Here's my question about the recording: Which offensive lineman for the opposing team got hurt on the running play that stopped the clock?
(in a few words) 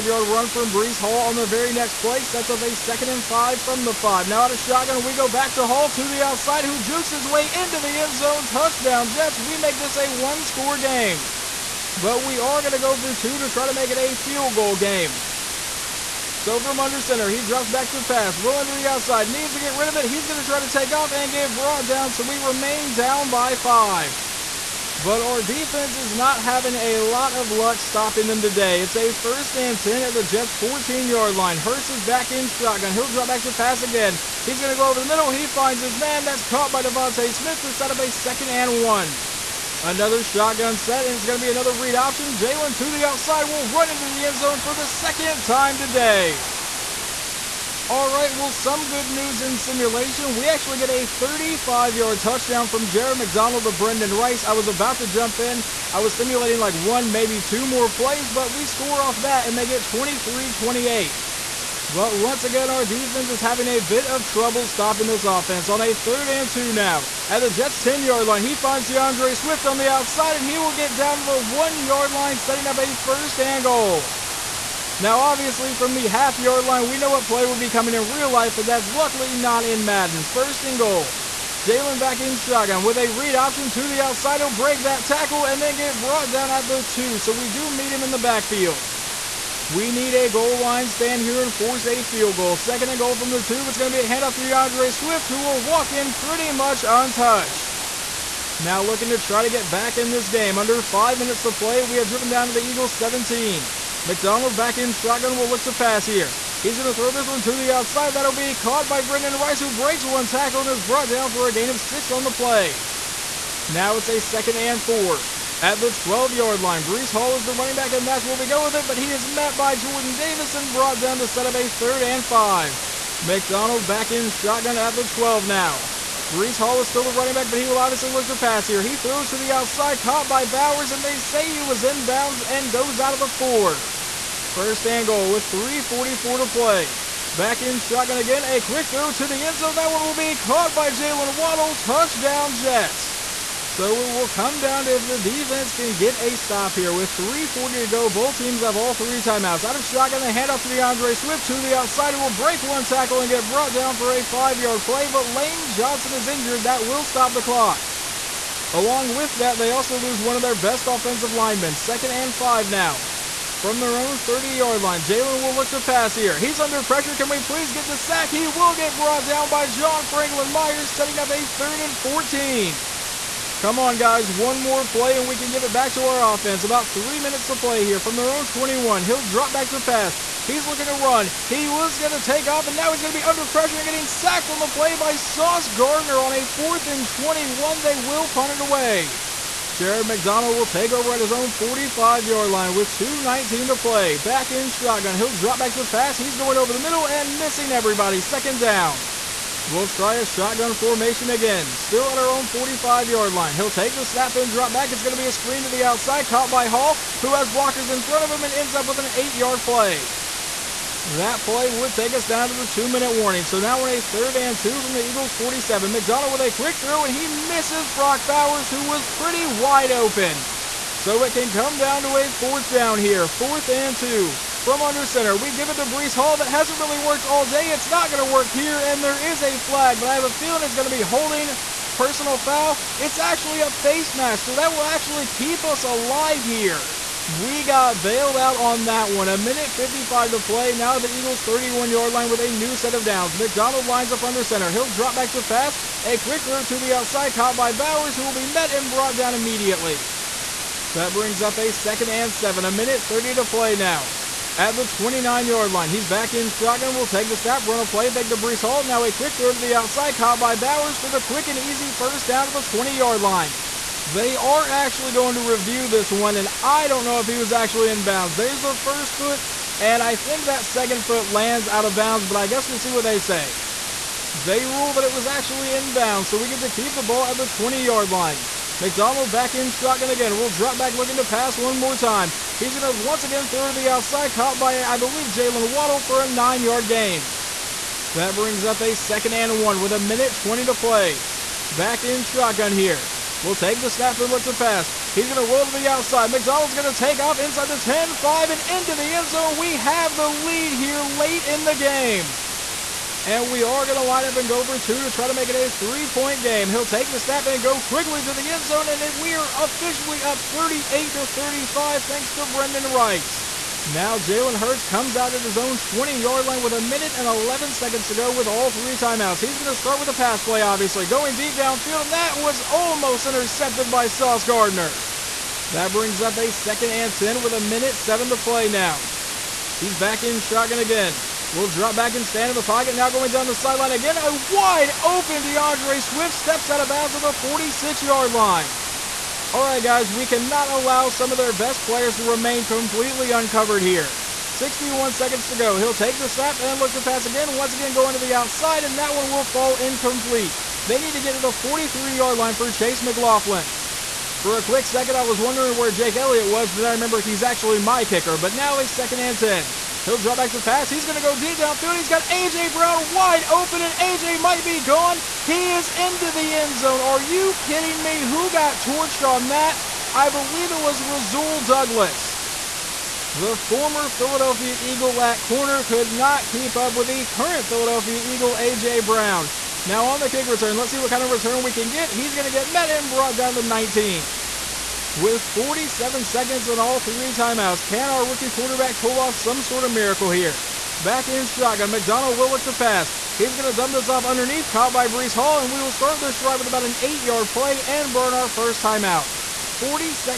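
Lane Johnson.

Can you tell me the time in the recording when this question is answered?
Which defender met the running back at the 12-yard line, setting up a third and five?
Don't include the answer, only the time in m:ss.
1:59.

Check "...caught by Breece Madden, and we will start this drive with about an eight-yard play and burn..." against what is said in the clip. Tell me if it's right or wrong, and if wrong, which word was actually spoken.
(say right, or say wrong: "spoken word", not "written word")
wrong: "Hall", not "Madden".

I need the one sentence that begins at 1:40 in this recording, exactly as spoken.
Under five minutes to play, we have driven down to the Eagles 17.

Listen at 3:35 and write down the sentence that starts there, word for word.
McDonald with a quick throw, and he misses Brock Bowers, who was pretty wide open.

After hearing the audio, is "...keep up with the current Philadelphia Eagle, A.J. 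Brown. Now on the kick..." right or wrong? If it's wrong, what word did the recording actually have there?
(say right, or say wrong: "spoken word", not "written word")
right.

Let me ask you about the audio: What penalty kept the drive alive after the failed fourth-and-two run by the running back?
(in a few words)
Face mask.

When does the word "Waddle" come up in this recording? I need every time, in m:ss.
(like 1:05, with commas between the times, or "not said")
2:21, 4:45.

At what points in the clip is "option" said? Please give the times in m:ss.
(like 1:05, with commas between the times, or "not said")
0:41, 1:23.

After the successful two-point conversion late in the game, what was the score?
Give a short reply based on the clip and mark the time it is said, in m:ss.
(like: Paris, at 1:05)
38 to 35, at 5:10.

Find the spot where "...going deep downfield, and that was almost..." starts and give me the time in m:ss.
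5:21.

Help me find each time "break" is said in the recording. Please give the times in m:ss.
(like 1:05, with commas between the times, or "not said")
1:24, 1:49, 2:32.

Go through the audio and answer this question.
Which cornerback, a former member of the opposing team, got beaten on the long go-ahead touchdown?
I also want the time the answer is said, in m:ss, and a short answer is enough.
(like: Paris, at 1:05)
Rasul Douglas, at 6:11.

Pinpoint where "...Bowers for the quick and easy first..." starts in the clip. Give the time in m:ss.
4:20.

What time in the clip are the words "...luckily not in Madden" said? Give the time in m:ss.
1:18.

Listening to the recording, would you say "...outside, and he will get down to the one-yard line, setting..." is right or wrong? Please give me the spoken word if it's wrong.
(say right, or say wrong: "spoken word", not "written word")
right.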